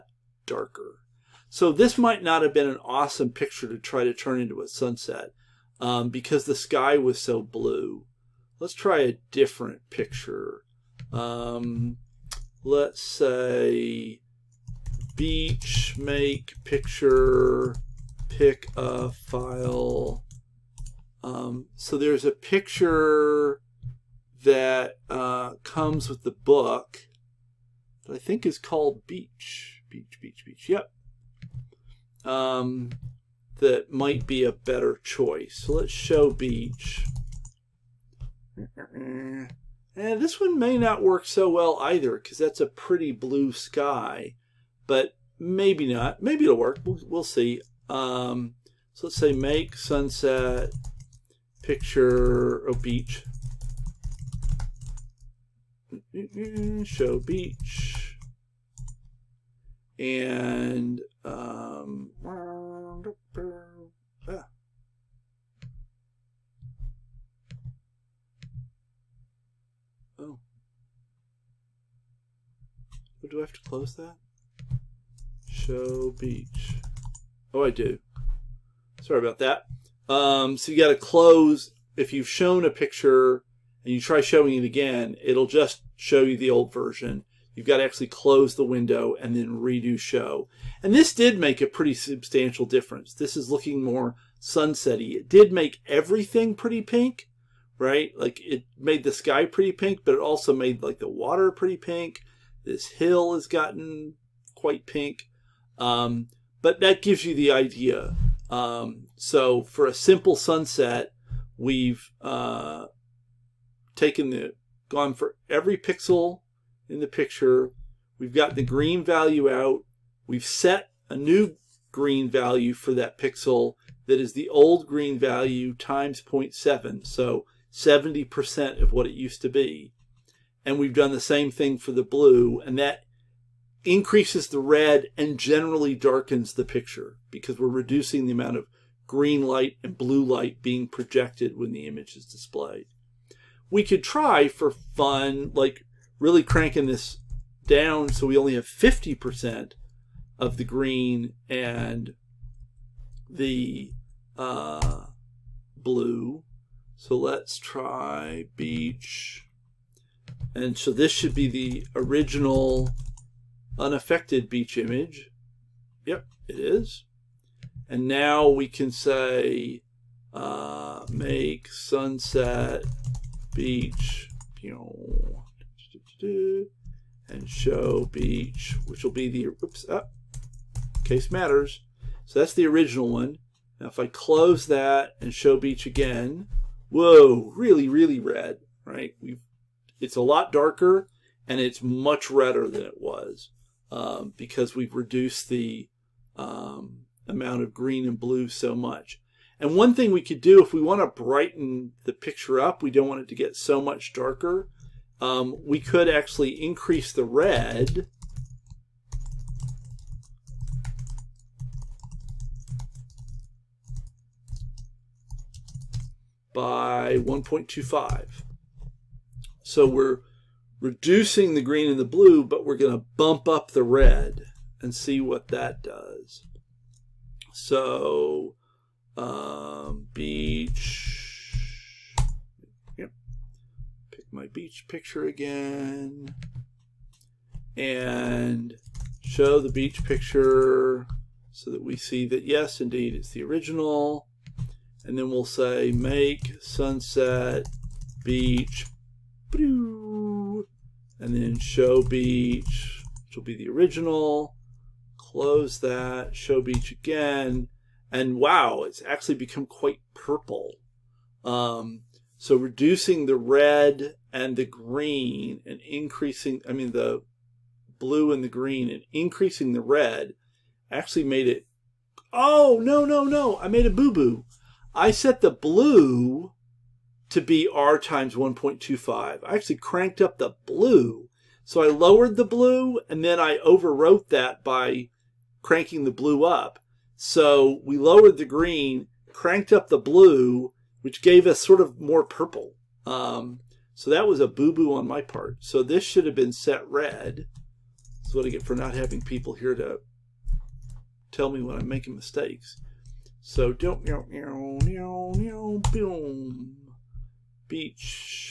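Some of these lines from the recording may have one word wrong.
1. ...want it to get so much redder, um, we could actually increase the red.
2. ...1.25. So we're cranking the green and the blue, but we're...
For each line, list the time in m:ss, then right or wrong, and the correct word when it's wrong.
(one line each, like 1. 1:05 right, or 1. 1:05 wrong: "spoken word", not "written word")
1. 3:23 wrong: "darker", not "redder"
2. 3:37 wrong: "reducing", not "cranking".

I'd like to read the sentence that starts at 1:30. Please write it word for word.
And this did make a pretty substantial difference.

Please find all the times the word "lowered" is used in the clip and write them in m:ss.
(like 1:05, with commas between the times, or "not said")
4:41, 4:47.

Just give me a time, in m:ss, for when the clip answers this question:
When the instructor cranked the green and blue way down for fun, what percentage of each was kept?
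2:28.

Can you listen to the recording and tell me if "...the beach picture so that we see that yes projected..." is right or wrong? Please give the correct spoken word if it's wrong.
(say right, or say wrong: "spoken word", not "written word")
wrong: "indeed", not "projected".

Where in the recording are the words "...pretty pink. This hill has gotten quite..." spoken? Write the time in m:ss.
1:41.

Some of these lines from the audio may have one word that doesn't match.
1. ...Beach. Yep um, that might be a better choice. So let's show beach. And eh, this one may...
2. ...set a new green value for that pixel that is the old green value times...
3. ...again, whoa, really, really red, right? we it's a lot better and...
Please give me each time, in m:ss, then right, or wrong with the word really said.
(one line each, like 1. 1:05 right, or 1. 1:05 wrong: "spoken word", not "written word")
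1. 0:30 right
2. 2:00 right
3. 3:05 wrong: "darker", not "better".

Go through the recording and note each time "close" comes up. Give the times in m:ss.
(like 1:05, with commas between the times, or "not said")
1:13, 1:20, 1:28, 3:04, 4:15.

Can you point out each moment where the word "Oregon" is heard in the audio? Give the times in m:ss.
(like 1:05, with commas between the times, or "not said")
not said.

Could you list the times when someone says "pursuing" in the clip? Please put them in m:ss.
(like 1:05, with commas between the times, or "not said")
not said.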